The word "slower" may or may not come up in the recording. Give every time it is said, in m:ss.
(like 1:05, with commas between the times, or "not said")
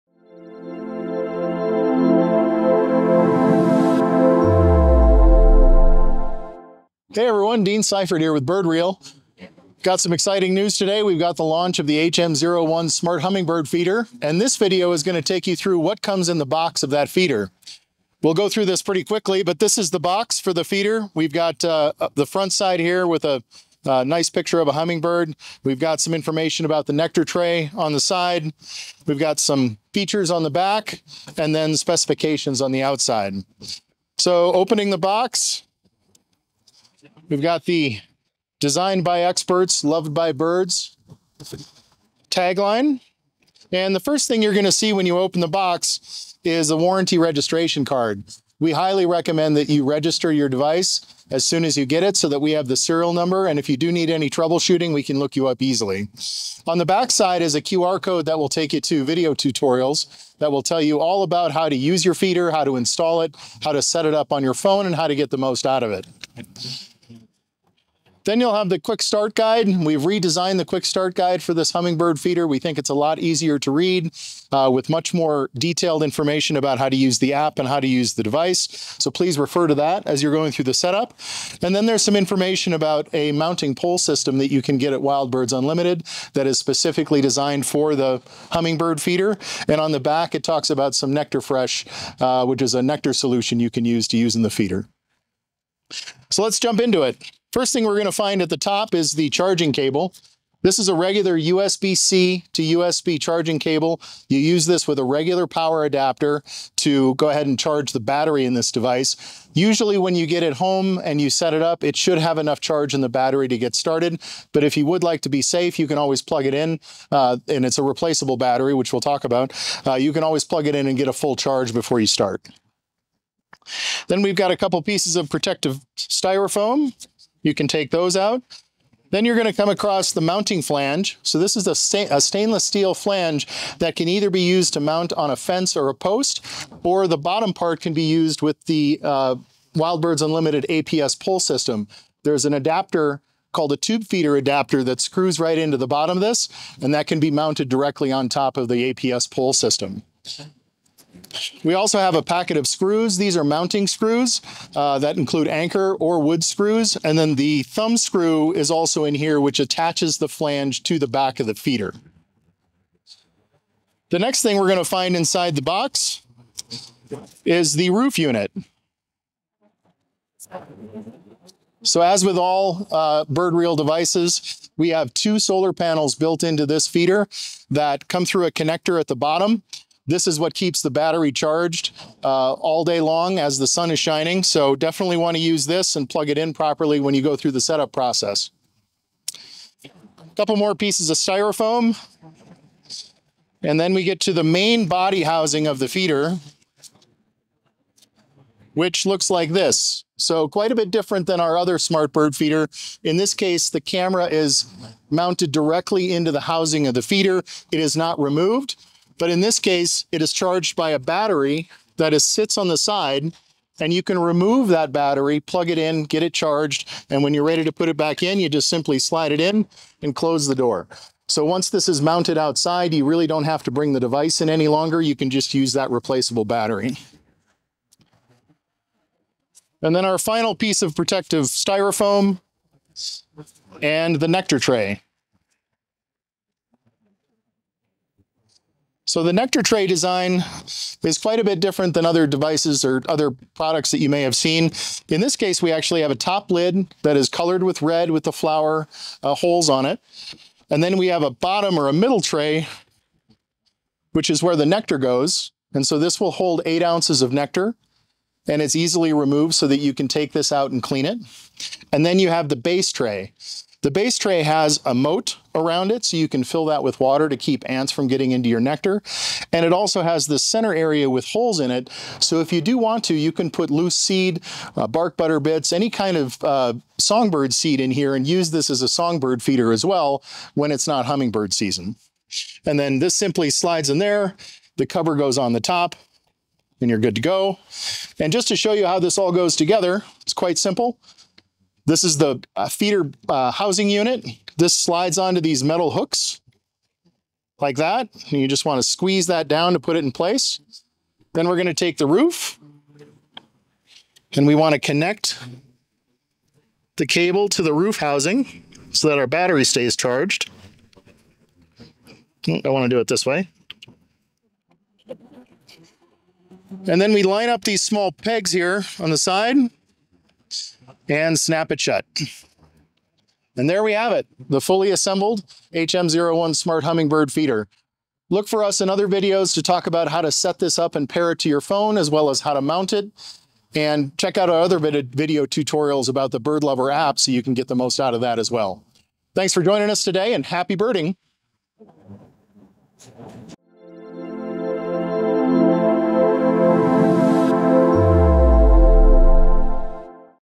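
not said.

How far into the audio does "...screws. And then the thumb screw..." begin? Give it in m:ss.
2:36.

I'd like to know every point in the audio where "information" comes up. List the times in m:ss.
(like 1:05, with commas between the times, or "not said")
0:26, 1:16, 1:22.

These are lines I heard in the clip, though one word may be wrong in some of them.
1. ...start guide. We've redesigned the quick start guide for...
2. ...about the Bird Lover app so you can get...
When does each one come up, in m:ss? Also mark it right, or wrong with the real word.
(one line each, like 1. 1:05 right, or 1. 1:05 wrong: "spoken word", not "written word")
1. 1:09 right
2. 5:36 right.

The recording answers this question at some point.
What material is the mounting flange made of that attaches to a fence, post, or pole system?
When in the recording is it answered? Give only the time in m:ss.
2:12.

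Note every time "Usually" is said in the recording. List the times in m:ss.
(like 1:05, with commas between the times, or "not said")
1:49.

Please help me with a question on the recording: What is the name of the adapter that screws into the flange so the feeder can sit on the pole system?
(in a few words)
Tube feeder adapter.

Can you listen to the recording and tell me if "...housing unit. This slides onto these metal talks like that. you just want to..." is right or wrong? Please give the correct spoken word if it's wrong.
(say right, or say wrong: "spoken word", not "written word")
wrong: "hooks", not "talks".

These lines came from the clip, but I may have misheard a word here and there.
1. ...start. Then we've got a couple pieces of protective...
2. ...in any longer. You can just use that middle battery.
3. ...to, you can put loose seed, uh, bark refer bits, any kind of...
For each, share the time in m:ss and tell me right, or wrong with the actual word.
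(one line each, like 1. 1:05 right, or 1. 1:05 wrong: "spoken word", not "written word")
1. 2:02 right
2. 3:44 wrong: "replaceable", not "middle"
3. 4:33 wrong: "butter", not "refer".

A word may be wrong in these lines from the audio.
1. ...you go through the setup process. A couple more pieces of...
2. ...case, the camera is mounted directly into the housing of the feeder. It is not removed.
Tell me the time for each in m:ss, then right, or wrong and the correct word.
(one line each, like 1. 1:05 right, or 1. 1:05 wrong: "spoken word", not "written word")
1. 3:07 right
2. 3:23 right.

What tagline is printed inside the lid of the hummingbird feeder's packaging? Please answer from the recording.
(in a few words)
Designed by experts, loved by birds.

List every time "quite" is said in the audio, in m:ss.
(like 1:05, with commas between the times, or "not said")
3:20, 4:01, 4:50.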